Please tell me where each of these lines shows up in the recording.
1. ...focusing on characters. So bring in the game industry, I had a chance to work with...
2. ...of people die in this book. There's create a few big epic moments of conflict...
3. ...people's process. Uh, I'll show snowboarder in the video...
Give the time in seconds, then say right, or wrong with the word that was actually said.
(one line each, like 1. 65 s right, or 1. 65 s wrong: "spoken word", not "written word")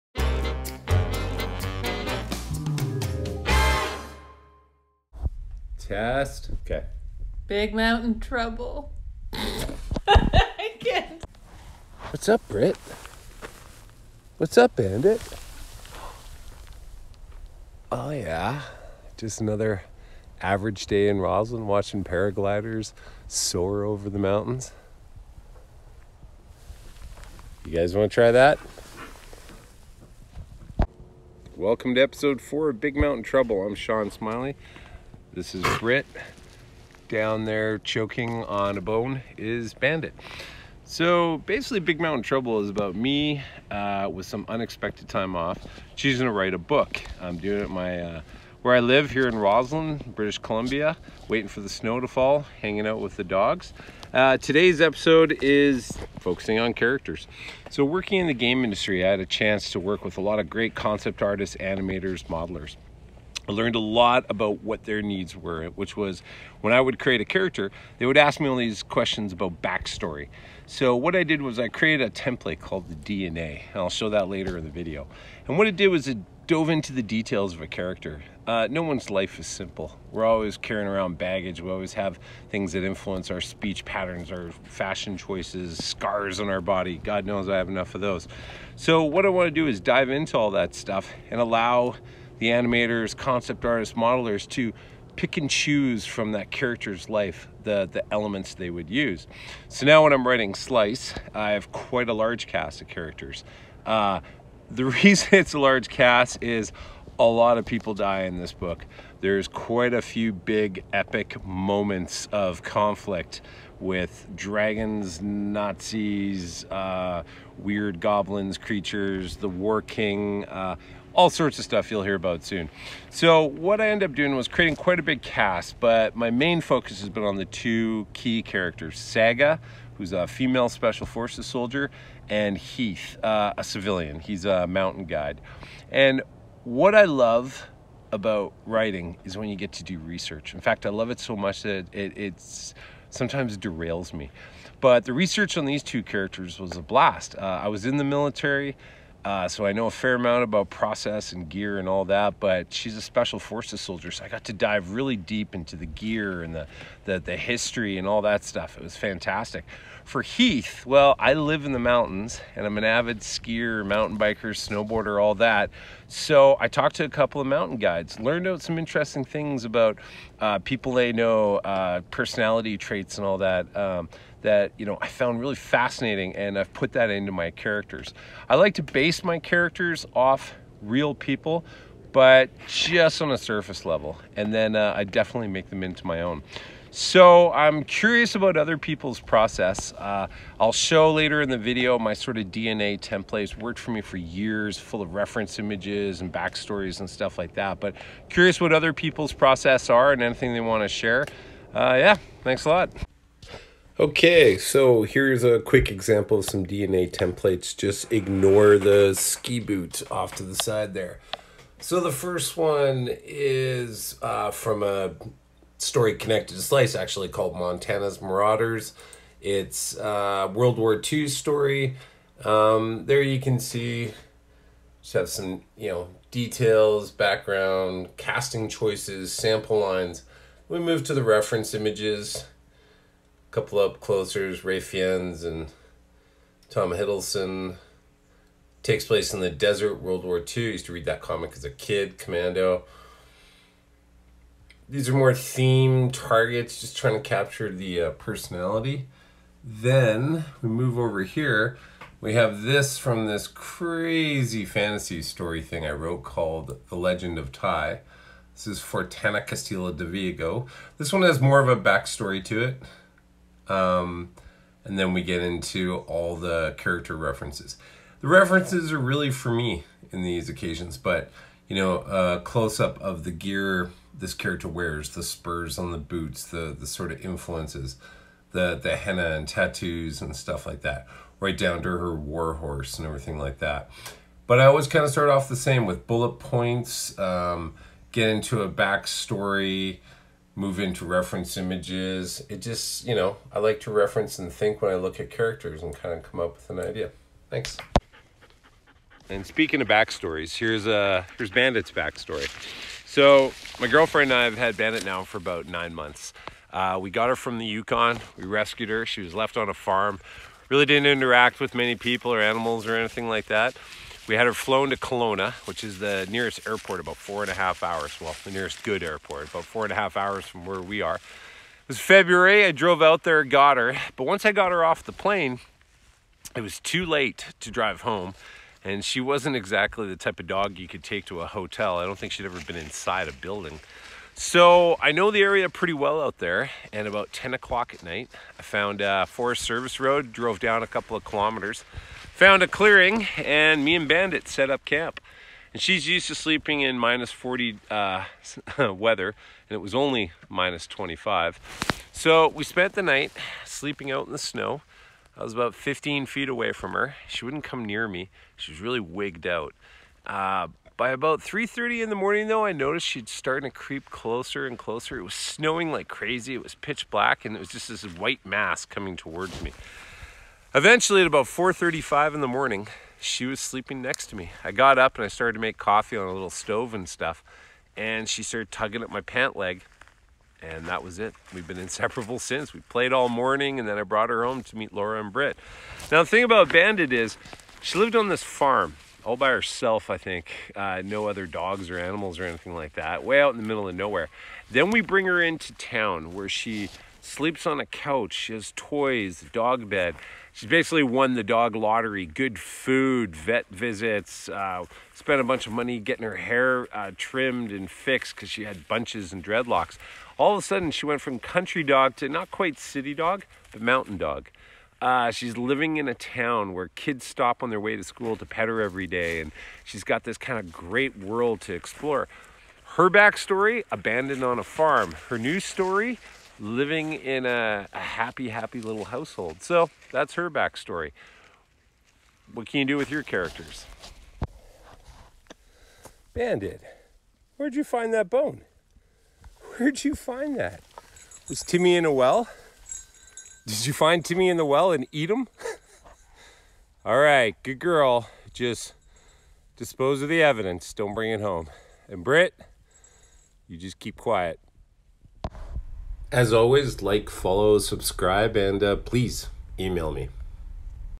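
1. 56 s wrong: "working", not "bring"
2. 107 s wrong: "quite", not "create"
3. 188 s wrong: "later", not "snowboarder".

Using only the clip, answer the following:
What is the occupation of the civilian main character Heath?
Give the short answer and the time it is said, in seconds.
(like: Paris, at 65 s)
Mountain guide, at 134 s.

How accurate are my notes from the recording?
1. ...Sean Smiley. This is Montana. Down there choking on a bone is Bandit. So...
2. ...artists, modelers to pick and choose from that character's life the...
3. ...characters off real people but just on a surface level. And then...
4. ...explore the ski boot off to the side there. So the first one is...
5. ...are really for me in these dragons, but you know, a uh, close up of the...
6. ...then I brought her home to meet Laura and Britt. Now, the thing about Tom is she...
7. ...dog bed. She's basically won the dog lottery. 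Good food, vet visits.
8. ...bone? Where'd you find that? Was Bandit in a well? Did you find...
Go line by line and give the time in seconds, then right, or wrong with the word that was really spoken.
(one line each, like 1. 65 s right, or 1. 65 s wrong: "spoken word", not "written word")
1. 33 s wrong: "Britt", not "Montana"
2. 93 s right
3. 179 s right
4. 208 s wrong: "ignore", not "explore"
5. 268 s wrong: "occasions", not "dragons"
6. 383 s wrong: "Bandit", not "Tom"
7. 399 s right
8. 438 s wrong: "Timmy", not "Bandit".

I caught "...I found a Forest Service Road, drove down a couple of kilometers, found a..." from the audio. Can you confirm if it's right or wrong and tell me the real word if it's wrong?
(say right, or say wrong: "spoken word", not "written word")
right.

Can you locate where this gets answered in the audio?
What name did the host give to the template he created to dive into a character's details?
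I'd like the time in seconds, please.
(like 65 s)
72 s.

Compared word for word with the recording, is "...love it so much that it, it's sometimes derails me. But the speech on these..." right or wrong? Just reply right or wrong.
wrong.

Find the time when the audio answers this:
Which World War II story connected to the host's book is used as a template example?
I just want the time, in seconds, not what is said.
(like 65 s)
217 s.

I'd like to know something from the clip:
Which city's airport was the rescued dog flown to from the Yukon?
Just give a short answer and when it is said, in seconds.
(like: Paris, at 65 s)
Kelowna, at 314 s.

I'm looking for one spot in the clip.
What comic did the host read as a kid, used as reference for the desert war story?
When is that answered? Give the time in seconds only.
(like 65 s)
242 s.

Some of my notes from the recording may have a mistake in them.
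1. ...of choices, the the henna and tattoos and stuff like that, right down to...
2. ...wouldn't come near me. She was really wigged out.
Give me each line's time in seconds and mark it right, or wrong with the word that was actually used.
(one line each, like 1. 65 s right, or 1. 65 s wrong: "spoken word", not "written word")
1. 277 s wrong: "influences", not "choices"
2. 357 s right.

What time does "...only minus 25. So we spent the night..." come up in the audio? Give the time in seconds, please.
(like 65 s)
349 s.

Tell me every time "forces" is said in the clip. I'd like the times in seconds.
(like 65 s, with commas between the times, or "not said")
131 s, 153 s.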